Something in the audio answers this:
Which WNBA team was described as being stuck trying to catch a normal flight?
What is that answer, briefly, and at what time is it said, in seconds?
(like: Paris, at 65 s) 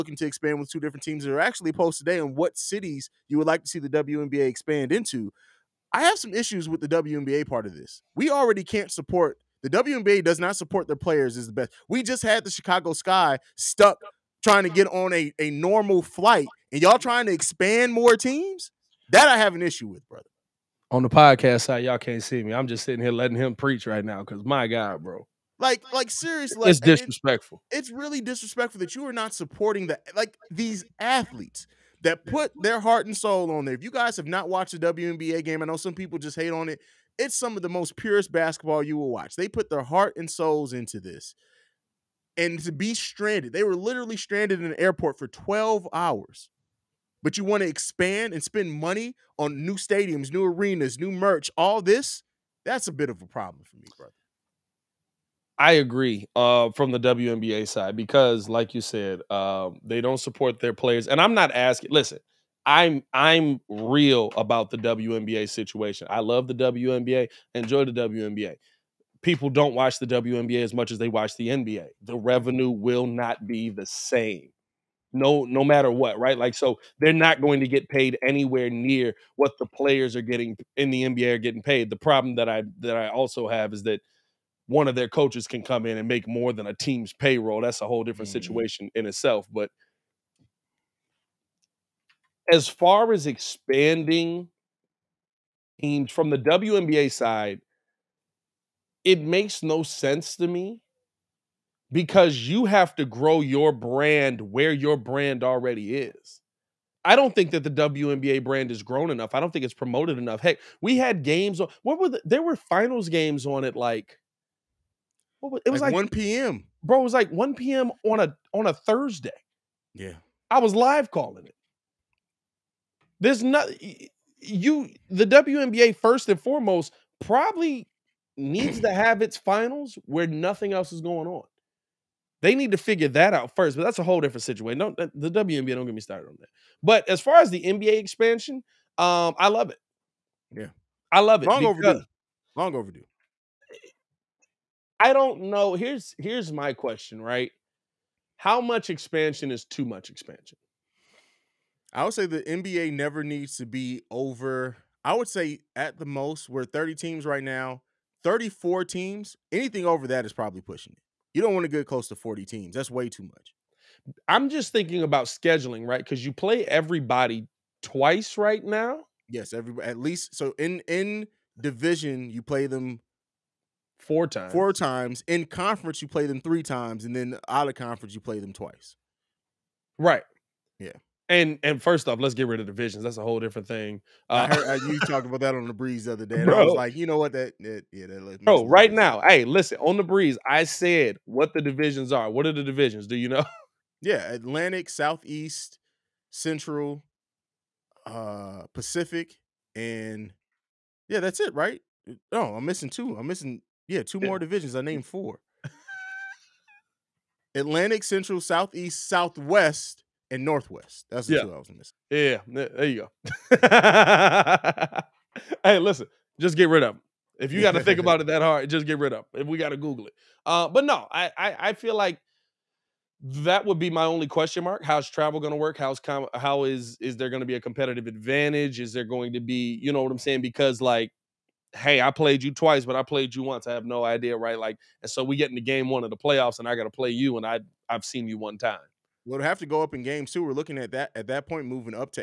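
Chicago Sky, at 12 s.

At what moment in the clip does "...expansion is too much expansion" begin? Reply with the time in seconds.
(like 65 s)
148 s.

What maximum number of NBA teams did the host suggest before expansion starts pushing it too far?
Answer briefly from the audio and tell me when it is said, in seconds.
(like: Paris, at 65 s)
34, at 158 s.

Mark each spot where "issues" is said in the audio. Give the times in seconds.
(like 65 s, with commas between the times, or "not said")
6 s, 19 s.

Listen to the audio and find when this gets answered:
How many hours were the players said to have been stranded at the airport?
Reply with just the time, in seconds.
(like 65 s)
45 s.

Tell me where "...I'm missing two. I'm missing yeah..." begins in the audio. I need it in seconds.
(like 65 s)
202 s.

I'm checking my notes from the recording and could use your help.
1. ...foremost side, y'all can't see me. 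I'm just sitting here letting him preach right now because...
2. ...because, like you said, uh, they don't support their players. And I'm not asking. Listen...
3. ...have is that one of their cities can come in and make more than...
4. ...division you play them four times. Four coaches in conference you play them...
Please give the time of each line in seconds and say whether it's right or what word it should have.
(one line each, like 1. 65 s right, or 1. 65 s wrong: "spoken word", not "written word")
1. 21 s wrong: "podcast", not "foremost"
2. 57 s right
3. 83 s wrong: "coaches", not "cities"
4. 171 s wrong: "times", not "coaches".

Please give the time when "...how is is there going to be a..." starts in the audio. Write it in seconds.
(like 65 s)
226 s.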